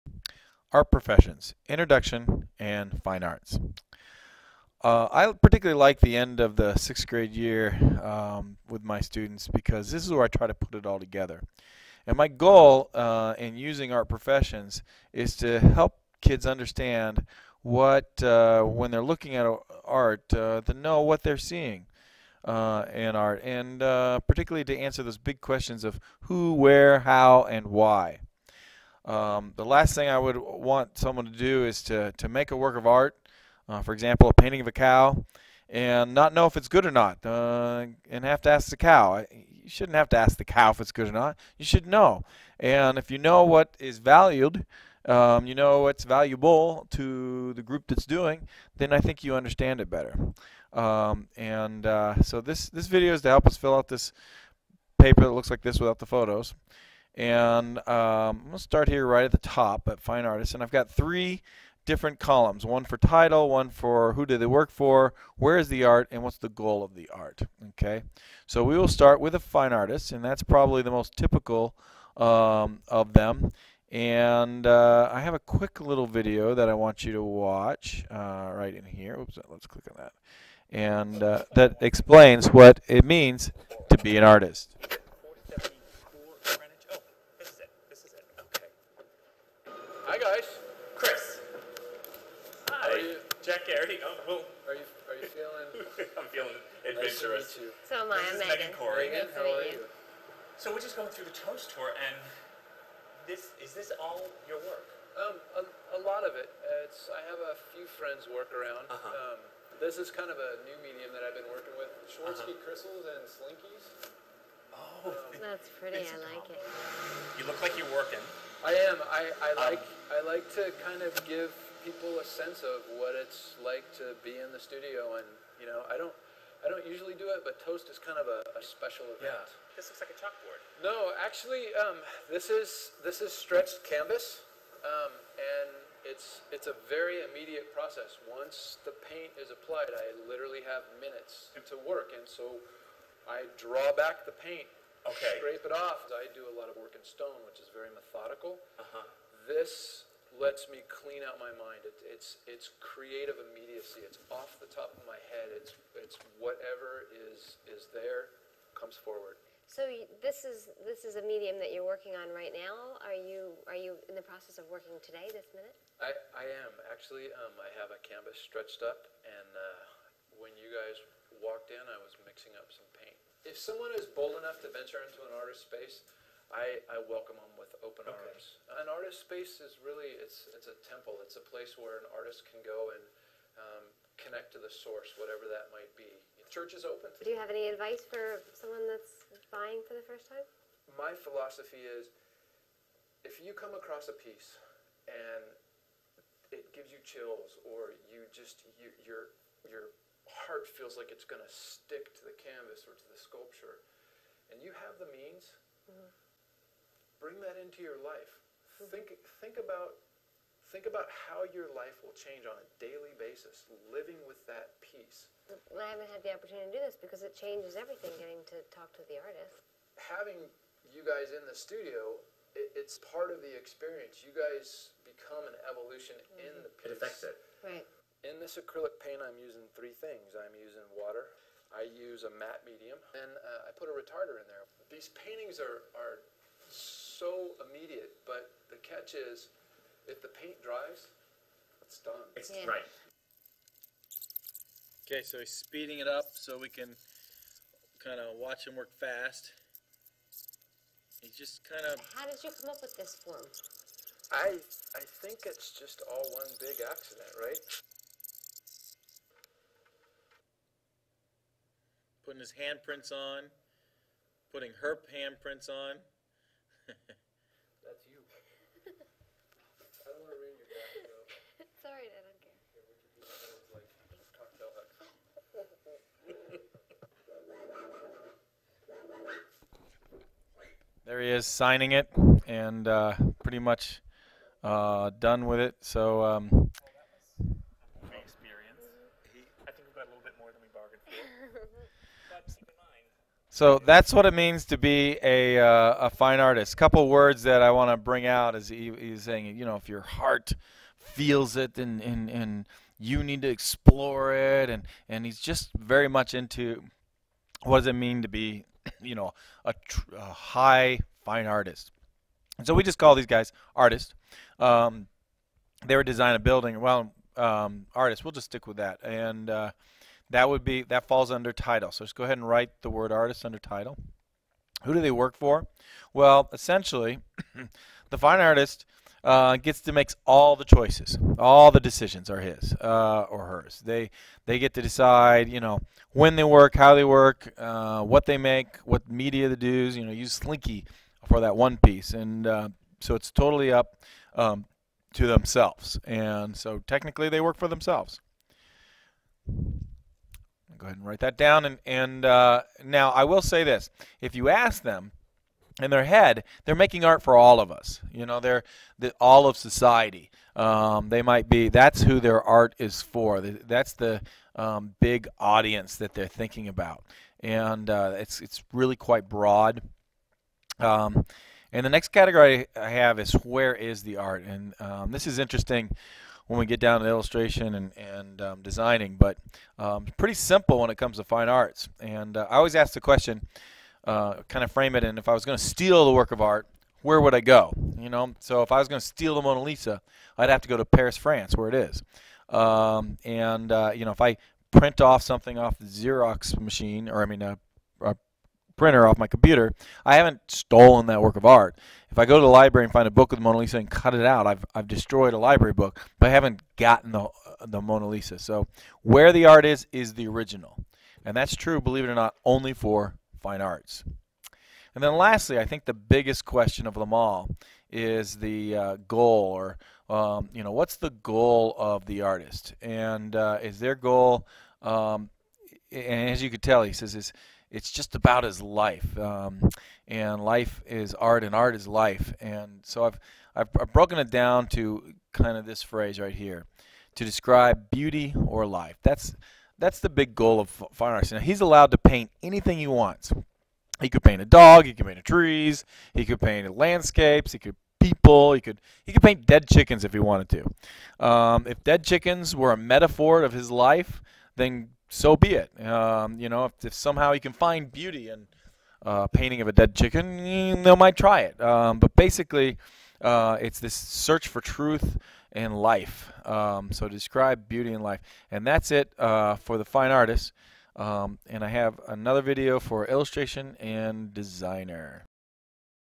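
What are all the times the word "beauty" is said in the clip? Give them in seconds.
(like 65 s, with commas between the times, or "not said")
437 s, 457 s, 467 s.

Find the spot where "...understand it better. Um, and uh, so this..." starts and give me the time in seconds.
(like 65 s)
49 s.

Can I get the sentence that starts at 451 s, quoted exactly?
Um, if dead chickens were a metaphor of his life, then so be it.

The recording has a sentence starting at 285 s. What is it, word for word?
So um, So that's what it means to be a, uh, a fine artist.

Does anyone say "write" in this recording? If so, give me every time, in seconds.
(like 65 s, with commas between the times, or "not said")
322 s, 351 s.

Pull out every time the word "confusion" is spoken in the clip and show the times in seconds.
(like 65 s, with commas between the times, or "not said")
not said.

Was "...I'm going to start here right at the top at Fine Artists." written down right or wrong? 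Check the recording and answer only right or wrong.
right.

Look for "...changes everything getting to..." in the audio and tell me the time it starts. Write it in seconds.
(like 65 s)
217 s.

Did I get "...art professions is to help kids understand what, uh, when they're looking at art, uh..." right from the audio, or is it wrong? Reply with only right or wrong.
right.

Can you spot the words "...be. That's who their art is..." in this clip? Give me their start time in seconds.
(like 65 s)
361 s.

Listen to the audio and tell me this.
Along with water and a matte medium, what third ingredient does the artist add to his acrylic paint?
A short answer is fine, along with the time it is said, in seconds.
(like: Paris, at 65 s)
A retarder, at 233 s.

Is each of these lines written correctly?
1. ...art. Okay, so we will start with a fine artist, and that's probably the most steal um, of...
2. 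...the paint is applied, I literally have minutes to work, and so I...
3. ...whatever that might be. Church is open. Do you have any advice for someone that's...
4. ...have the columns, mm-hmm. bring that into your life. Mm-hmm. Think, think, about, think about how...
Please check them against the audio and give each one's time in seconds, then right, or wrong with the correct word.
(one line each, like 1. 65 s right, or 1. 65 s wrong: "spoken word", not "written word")
1. 67 s wrong: "typical", not "steal"
2. 138 s right
3. 185 s right
4. 204 s wrong: "means", not "columns".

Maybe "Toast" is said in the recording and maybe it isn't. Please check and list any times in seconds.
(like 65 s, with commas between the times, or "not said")
101 s, 127 s.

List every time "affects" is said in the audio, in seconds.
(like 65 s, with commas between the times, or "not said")
226 s.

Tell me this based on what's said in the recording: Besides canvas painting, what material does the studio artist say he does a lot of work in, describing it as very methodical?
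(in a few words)
Stone.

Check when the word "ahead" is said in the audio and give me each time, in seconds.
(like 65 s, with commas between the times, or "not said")
322 s, 350 s.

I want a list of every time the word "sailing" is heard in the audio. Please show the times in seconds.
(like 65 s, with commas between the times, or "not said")
not said.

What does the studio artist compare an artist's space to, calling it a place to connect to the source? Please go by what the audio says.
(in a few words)
A temple.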